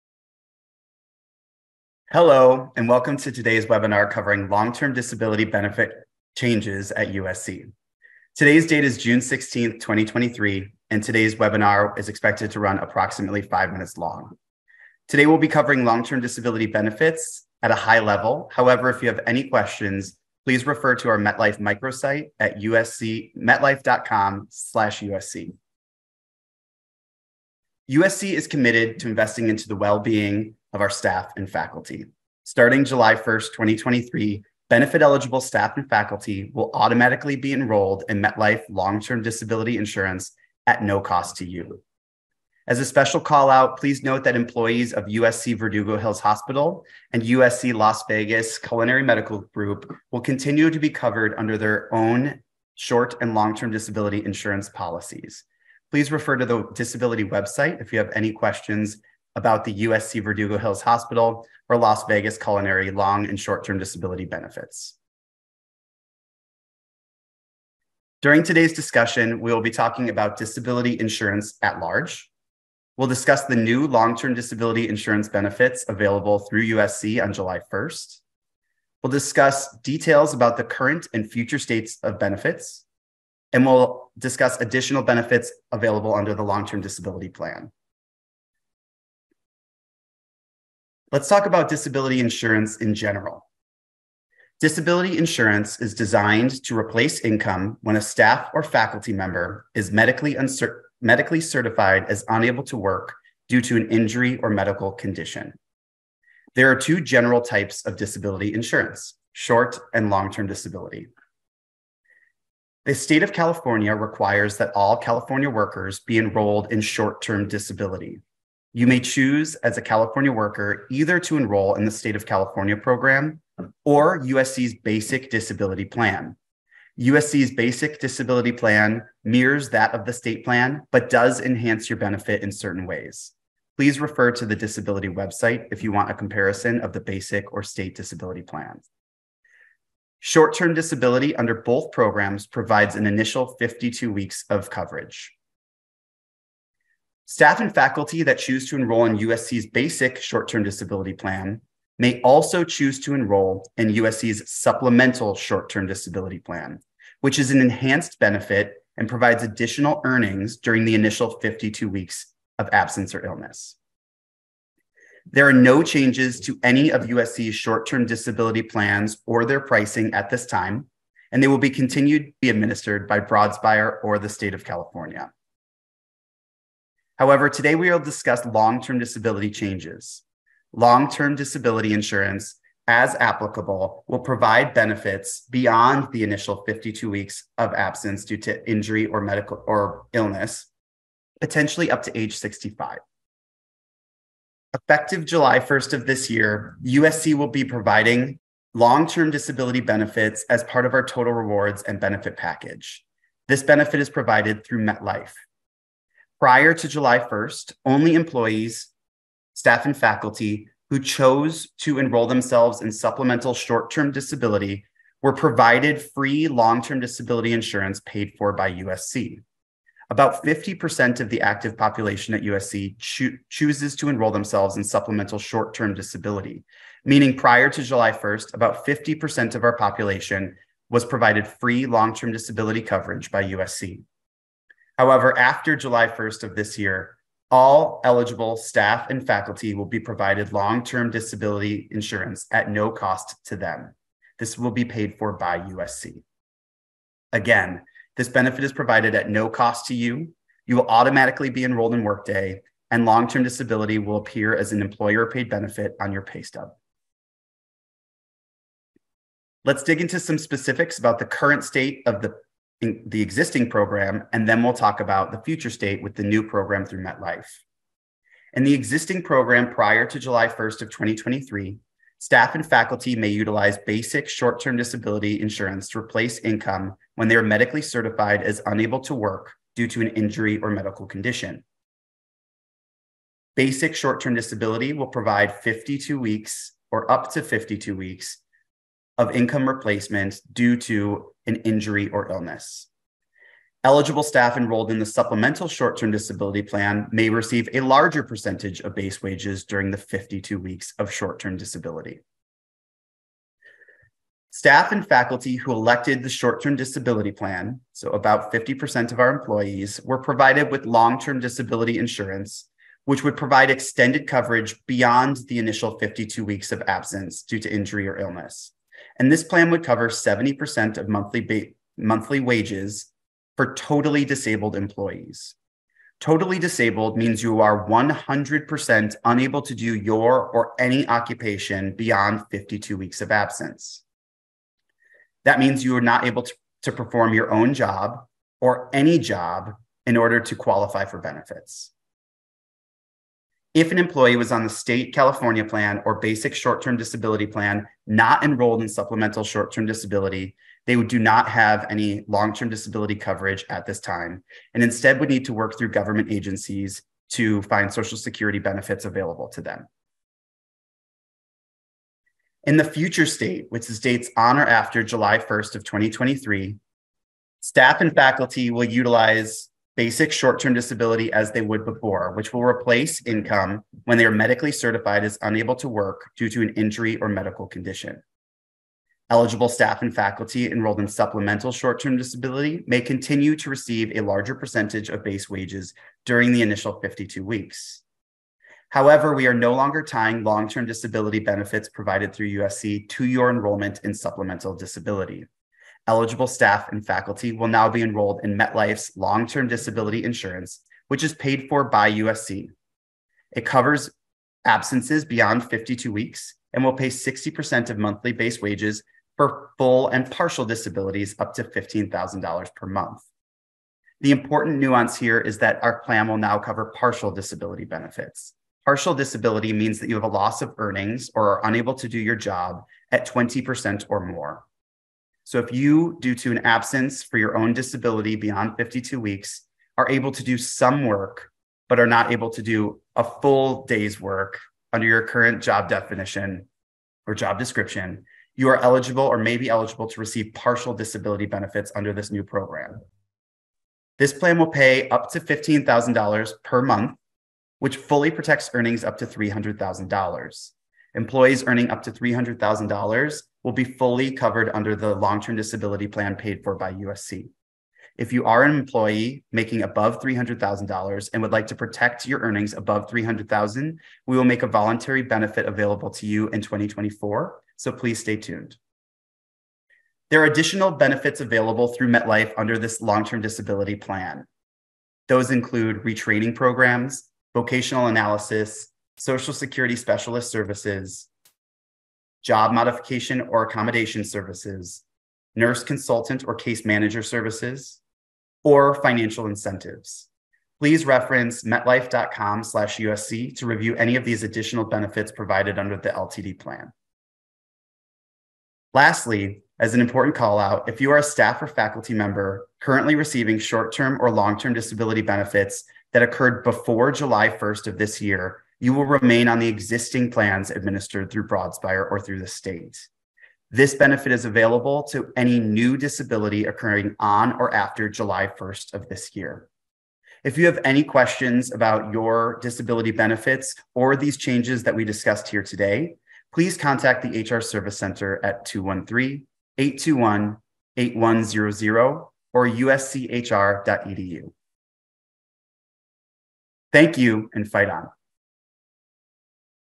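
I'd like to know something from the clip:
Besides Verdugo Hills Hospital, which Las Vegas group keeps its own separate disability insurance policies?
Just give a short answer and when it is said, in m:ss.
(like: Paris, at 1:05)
USC Las Vegas Culinary Medical Group, at 0:47.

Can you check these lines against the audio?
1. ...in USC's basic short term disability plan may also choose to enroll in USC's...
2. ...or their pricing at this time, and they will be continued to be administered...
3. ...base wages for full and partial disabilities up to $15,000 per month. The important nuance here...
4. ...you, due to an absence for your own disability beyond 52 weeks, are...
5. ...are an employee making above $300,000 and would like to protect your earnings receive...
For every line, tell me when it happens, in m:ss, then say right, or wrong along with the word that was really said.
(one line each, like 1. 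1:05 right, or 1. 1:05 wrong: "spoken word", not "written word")
1. 2:29 right
2. 2:49 right
3. 6:48 right
4. 7:05 right
5. 7:38 wrong: "above", not "receive".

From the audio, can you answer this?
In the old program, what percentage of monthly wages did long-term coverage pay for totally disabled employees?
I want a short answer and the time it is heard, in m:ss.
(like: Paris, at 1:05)
70%, at 5:20.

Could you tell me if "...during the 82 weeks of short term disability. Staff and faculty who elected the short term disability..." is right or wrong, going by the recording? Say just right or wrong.
wrong.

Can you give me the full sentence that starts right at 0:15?
Today, we'll be covering long-term disability benefits at a high level.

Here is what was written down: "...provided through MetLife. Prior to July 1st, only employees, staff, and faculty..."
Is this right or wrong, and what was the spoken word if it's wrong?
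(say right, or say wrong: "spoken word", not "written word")
right.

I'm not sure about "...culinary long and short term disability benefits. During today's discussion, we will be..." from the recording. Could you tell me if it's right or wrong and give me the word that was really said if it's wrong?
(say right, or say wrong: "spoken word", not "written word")
right.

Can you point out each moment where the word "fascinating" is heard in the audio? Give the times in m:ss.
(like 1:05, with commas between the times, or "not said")
not said.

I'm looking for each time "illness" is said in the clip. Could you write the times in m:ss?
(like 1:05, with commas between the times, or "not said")
2:43, 3:10, 4:52, 5:18.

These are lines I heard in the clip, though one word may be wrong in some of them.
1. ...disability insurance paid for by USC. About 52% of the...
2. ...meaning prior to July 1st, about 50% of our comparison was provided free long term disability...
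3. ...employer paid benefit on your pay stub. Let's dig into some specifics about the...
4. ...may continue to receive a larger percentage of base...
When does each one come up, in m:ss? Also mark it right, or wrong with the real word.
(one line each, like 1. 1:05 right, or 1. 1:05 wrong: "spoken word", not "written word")
1. 3:36 wrong: "50", not "52"
2. 3:47 wrong: "population", not "comparison"
3. 4:14 right
4. 6:22 right.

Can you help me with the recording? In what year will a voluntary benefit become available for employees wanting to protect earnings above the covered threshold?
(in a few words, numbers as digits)
2024.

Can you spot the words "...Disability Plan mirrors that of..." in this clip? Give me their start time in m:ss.
2:07.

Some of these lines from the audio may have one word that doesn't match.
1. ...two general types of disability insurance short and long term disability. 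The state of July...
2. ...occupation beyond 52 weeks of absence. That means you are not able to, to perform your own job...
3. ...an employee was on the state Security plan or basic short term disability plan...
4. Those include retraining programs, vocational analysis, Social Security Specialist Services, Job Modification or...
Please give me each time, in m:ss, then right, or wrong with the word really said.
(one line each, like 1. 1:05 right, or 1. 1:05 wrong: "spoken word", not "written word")
1. 1:46 wrong: "California", not "July"
2. 5:31 right
3. 5:43 wrong: "California", not "Security"
4. 7:55 right.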